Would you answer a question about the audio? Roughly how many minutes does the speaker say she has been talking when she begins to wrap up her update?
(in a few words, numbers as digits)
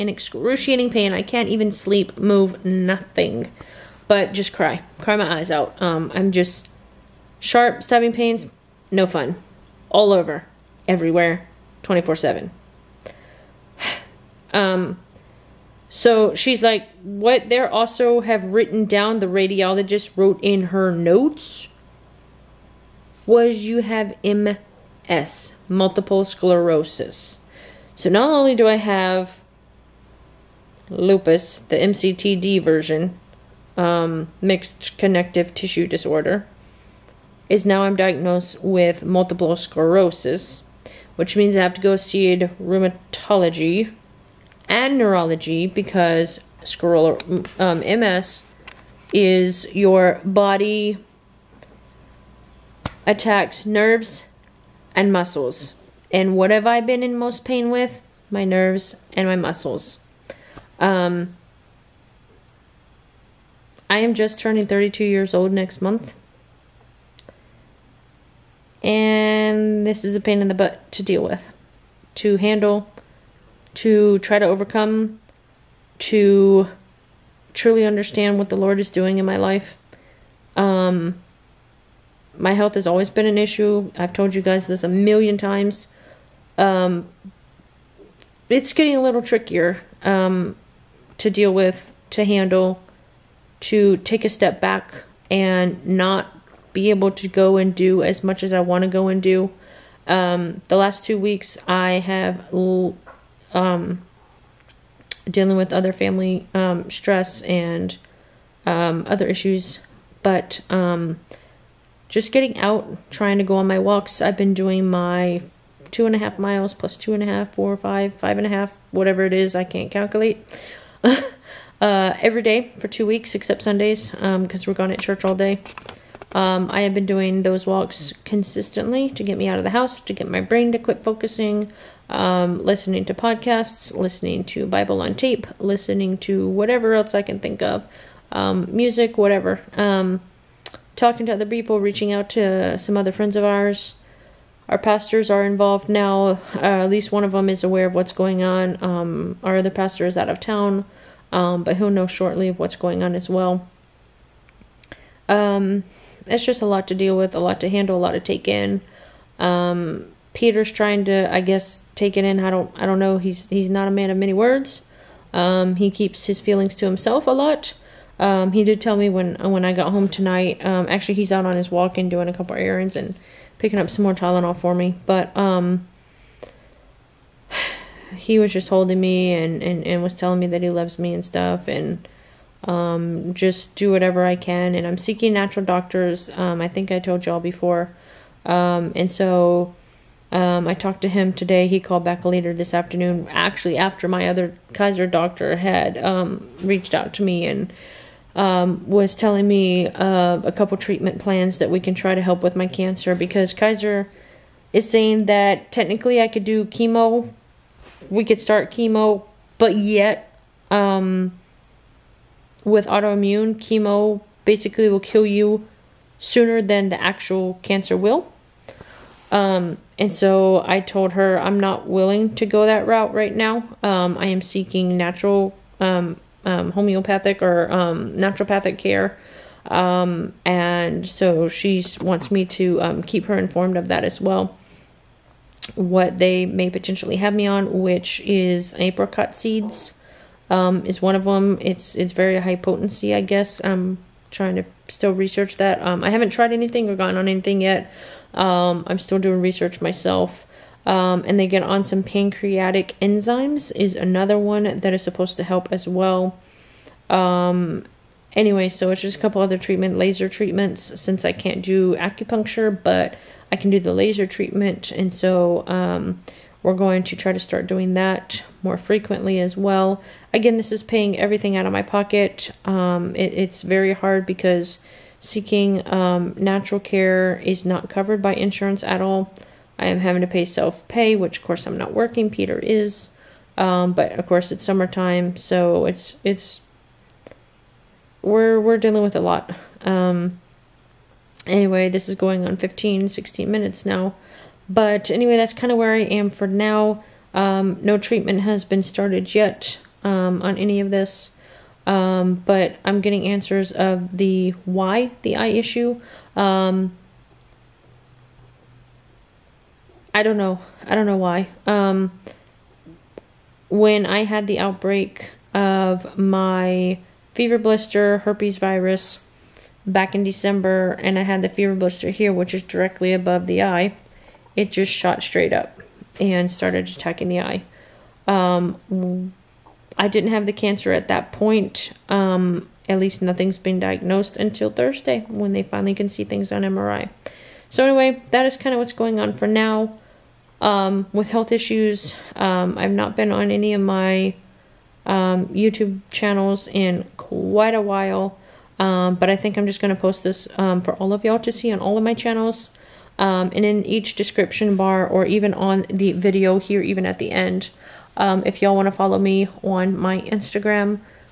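15 or 16 minutes.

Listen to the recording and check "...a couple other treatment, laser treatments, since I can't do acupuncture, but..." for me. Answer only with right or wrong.
right.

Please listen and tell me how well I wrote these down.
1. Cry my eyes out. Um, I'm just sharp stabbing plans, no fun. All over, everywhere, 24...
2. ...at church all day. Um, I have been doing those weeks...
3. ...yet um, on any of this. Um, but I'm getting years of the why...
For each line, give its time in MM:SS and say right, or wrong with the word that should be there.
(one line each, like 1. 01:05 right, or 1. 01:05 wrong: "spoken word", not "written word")
1. 00:04 wrong: "pains", not "plans"
2. 02:04 wrong: "walks", not "weeks"
3. 04:59 wrong: "answers", not "years".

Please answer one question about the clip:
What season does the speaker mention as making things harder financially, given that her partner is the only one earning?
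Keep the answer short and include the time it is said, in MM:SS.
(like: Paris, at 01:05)
Summertime, at 04:44.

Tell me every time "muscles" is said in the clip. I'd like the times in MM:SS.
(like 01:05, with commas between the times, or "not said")
00:55, 00:59.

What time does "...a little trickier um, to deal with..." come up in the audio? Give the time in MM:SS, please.
01:28.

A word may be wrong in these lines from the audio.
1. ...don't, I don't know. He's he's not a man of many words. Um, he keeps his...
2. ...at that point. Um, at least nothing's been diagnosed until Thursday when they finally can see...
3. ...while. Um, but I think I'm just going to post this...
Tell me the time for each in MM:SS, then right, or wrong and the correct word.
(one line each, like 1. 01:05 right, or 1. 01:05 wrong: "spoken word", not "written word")
1. 02:42 right
2. 05:30 right
3. 05:47 right.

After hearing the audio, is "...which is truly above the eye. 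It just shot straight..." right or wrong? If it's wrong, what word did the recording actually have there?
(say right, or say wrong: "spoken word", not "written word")
wrong: "directly", not "truly".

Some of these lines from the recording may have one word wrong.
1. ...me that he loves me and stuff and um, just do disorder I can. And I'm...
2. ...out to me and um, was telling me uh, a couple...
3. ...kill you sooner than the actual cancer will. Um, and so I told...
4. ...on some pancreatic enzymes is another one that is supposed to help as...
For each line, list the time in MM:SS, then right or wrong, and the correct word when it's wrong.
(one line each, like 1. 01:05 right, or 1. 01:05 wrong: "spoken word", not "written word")
1. 03:00 wrong: "whatever", not "disorder"
2. 03:16 right
3. 03:34 right
4. 04:11 right.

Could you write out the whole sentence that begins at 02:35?
Um, it's just a lot to deal with, a lot to handle, a lot to take in.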